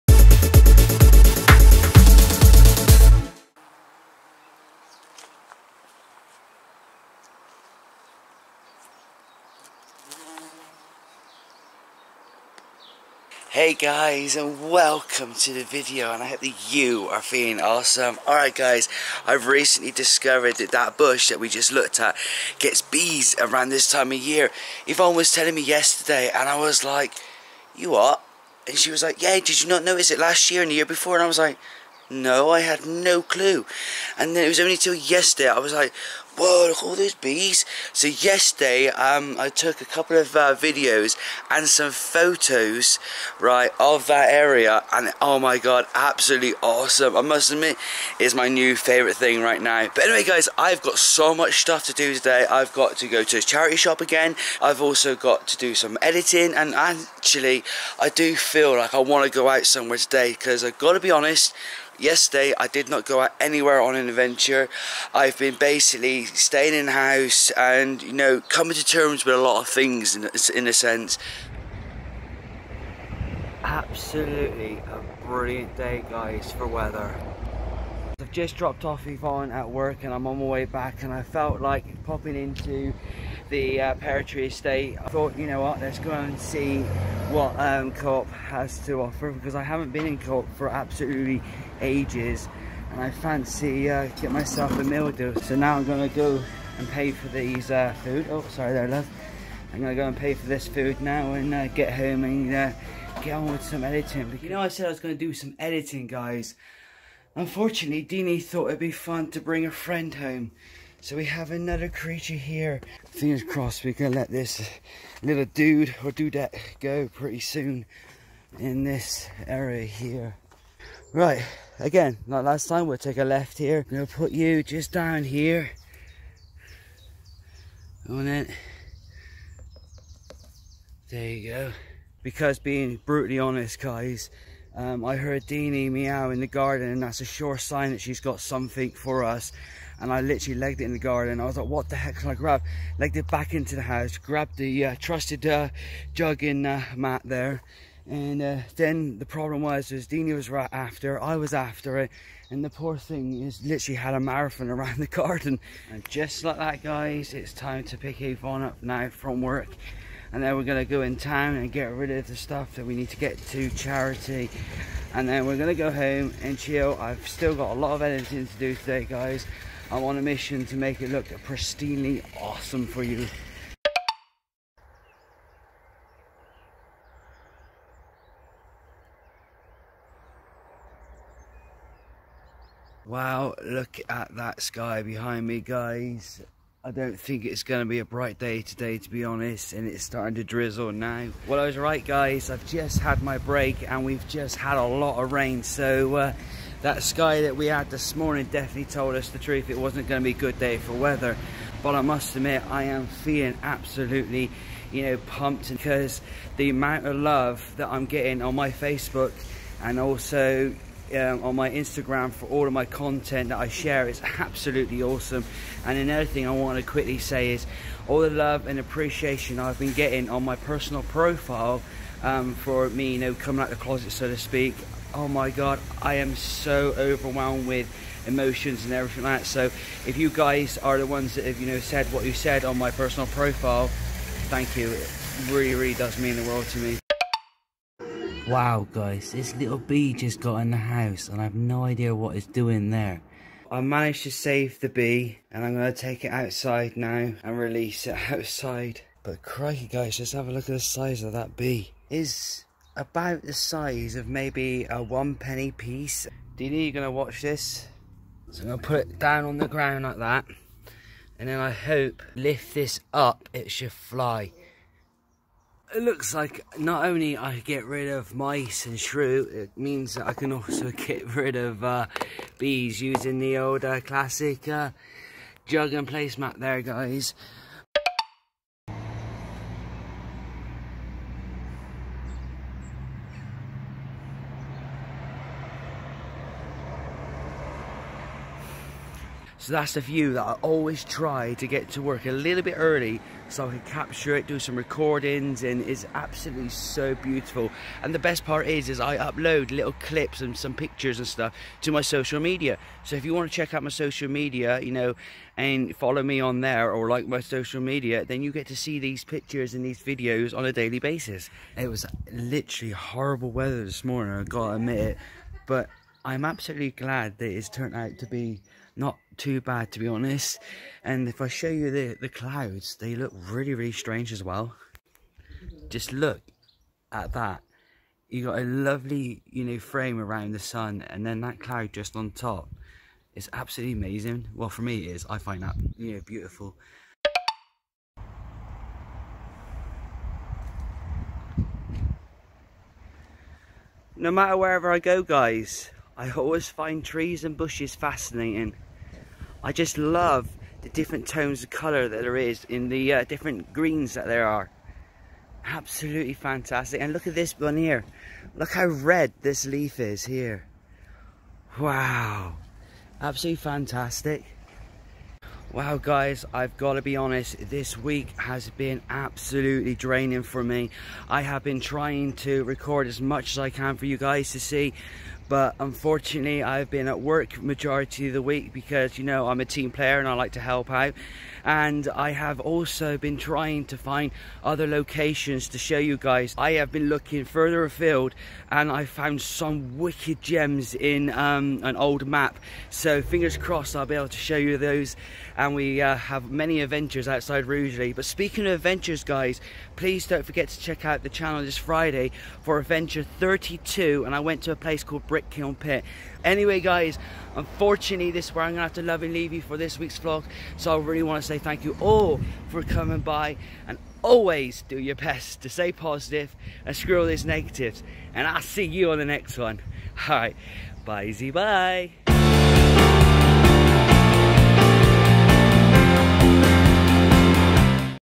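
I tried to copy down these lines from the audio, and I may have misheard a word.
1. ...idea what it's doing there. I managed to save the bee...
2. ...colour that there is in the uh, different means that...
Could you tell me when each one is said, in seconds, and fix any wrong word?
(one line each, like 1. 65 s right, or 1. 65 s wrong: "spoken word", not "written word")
1. 241 s right
2. 351 s wrong: "greens", not "means".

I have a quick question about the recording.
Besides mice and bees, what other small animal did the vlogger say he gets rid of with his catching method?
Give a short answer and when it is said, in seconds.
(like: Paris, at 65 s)
Shrew, at 268 s.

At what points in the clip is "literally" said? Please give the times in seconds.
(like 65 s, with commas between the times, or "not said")
140 s, 153 s, 312 s.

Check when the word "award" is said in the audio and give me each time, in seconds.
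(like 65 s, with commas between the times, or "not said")
not said.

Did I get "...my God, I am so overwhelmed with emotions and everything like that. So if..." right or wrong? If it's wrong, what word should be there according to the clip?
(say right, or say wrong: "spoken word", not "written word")
right.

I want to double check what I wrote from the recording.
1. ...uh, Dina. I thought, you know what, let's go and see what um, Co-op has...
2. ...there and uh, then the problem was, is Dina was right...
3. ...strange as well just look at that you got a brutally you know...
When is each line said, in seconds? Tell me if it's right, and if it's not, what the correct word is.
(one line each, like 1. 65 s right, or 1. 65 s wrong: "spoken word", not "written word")
1. 83 s wrong: "Estate", not "Dina"
2. 147 s right
3. 323 s wrong: "lovely", not "brutally".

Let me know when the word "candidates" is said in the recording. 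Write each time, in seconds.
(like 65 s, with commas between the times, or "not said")
not said.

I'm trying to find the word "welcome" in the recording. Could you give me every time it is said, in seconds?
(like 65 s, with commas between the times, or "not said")
14 s.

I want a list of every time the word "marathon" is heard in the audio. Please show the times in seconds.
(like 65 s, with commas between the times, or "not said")
154 s.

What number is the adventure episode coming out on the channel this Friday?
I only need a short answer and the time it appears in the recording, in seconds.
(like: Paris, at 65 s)
32, at 402 s.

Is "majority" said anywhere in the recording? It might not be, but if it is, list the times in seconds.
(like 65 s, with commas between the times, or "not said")
377 s.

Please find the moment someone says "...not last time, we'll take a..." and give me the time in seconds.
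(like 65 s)
122 s.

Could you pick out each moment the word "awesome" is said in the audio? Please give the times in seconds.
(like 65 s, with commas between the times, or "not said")
17 s, 46 s, 172 s, 215 s.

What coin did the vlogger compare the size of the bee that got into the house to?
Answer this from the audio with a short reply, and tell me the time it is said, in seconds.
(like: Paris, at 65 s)
One penny piece, at 255 s.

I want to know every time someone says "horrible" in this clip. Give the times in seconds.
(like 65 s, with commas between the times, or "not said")
312 s.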